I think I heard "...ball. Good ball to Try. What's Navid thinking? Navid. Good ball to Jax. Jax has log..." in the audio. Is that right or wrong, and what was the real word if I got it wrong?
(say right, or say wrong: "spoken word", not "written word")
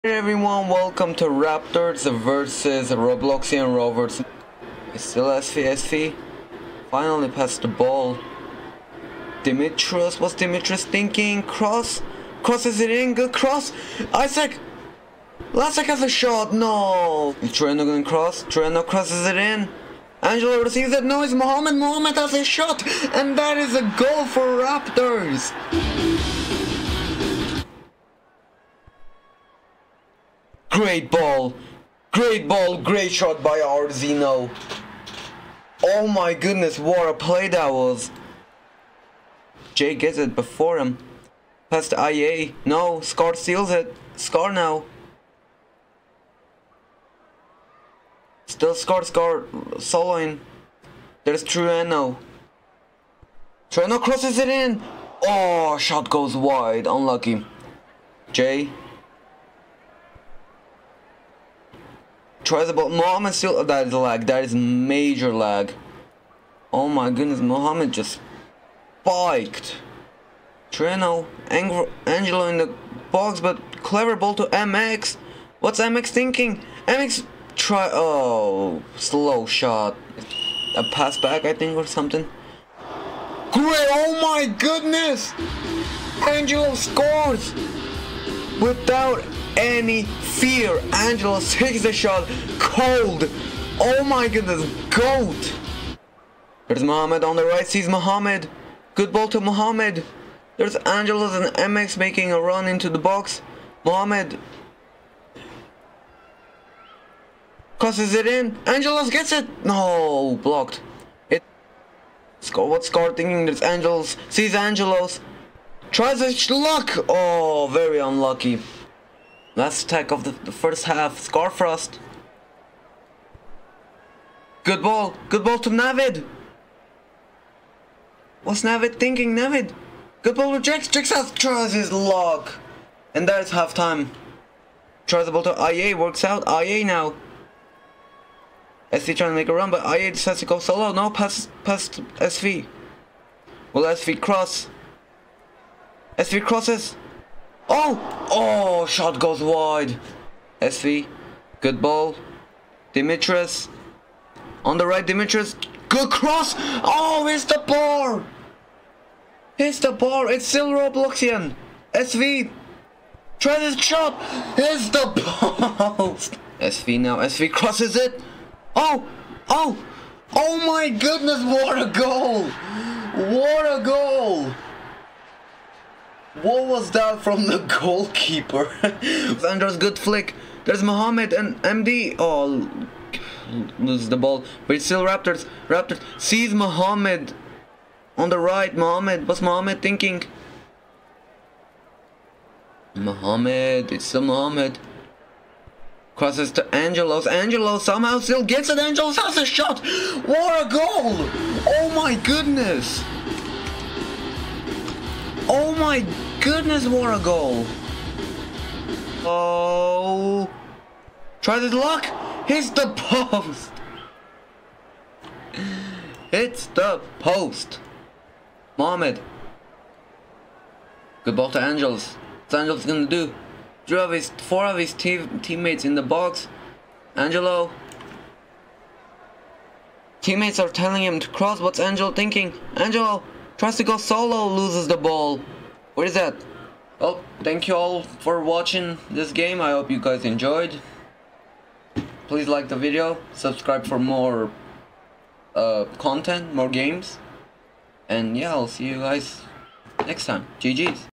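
wrong: "Navid", not "Try".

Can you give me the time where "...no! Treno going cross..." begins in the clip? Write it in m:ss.
0:16.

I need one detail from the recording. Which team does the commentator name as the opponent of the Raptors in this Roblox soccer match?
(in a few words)
Robloxian Rovers.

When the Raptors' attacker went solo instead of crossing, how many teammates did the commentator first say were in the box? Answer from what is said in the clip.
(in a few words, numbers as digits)
3.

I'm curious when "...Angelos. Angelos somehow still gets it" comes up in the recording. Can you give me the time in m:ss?
3:16.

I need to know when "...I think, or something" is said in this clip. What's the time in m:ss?
1:21.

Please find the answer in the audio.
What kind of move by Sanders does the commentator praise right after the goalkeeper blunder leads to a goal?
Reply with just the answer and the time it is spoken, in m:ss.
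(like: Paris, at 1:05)
flick, at 2:59.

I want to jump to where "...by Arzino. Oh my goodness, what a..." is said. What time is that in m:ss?
0:33.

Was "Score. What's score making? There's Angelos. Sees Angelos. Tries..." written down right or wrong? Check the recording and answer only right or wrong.
wrong.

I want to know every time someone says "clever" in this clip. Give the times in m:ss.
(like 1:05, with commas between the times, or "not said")
1:13.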